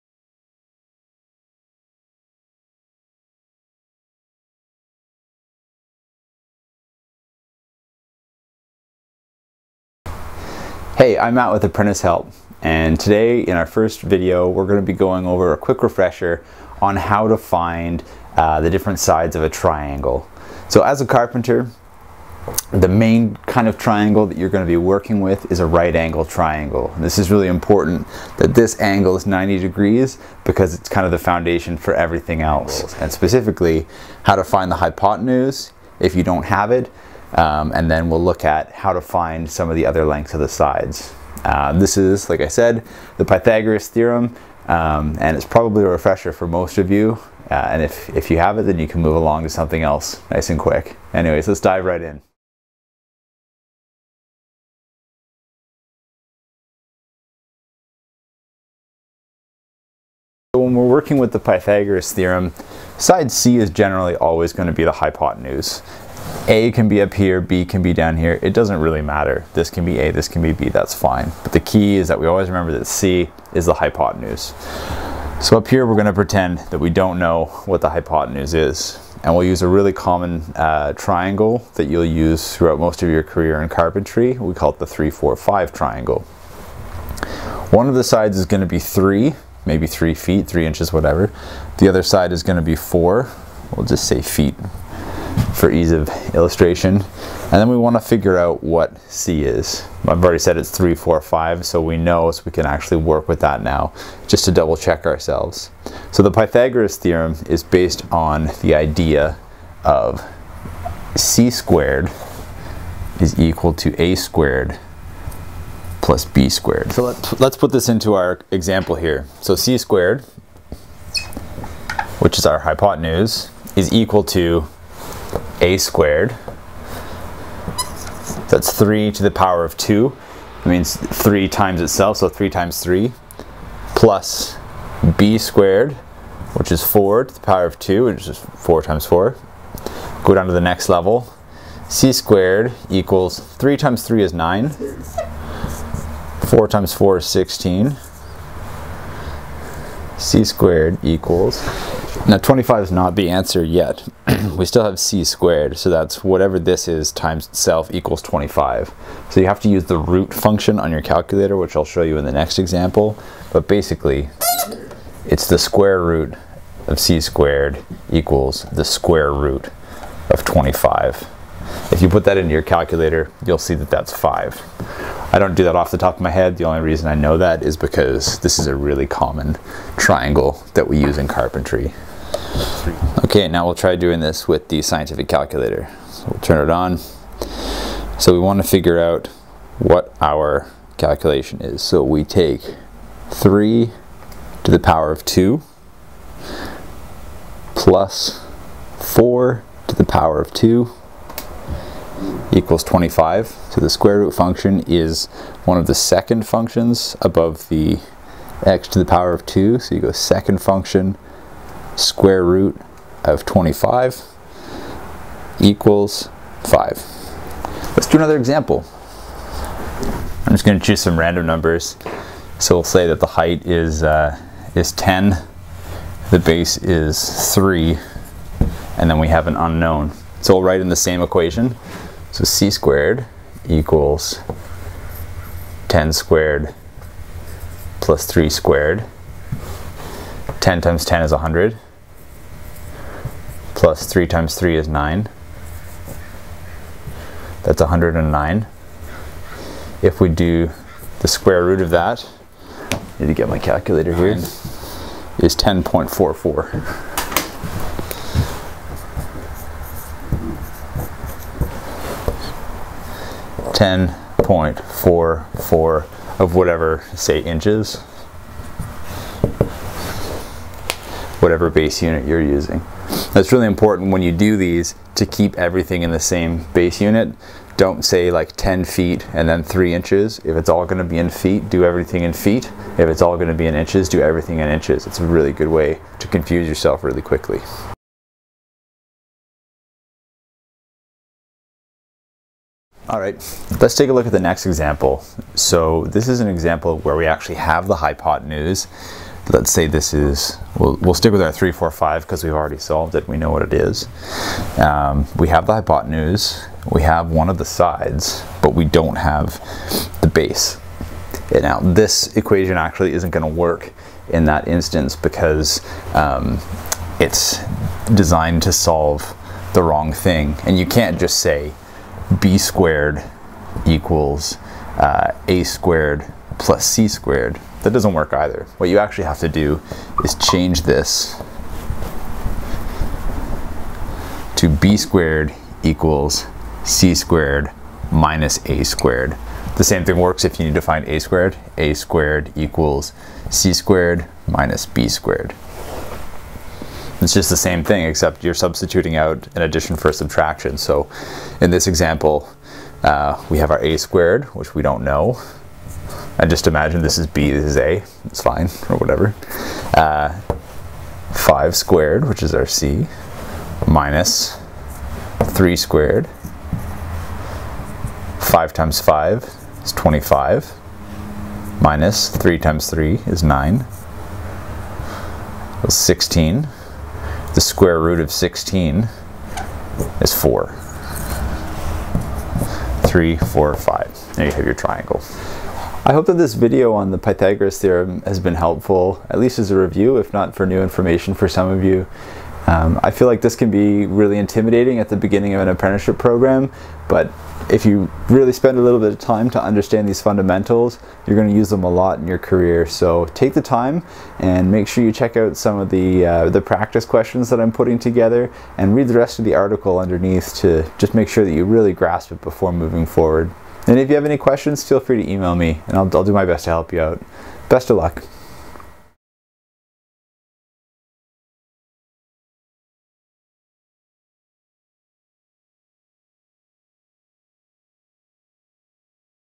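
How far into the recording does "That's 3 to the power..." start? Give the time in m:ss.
2:08.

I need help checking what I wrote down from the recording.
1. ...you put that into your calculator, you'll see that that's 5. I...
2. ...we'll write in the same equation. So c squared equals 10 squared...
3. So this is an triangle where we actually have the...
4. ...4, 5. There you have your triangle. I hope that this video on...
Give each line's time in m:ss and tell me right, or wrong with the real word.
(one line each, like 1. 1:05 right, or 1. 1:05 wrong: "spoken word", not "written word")
1. 2:52 right
2. 3:50 right
3. 4:55 wrong: "example", not "triangle"
4. 6:23 right.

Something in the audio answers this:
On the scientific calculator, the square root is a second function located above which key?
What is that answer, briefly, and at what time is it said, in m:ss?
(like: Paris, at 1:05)
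x to the power of 2, at 3:28.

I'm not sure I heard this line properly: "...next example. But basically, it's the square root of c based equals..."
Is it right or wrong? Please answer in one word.
wrong.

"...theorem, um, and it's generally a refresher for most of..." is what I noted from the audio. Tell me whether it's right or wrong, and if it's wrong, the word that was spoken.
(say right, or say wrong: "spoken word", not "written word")
wrong: "probably", not "generally".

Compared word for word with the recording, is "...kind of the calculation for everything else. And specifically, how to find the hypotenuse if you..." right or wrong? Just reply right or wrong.
wrong.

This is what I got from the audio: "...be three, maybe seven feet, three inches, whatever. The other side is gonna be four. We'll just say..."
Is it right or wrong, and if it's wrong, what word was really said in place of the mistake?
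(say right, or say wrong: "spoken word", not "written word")
wrong: "three", not "seven".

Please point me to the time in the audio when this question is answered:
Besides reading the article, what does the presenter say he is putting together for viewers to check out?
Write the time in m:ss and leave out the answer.
6:46.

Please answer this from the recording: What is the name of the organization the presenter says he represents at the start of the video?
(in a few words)
Apprentice Help.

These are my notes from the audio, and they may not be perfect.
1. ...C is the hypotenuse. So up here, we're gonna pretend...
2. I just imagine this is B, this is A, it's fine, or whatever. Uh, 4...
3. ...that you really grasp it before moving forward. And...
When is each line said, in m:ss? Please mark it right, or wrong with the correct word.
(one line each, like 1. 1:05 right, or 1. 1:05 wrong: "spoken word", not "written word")
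1. 1:12 right
2. 5:56 wrong: "5", not "4"
3. 6:51 right.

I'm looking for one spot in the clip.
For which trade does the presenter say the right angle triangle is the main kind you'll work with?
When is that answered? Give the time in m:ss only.
0:21.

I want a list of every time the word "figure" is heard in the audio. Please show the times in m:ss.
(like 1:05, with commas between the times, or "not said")
1:37, 3:08.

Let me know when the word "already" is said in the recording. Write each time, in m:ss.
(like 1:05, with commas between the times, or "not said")
1:40, 5:02.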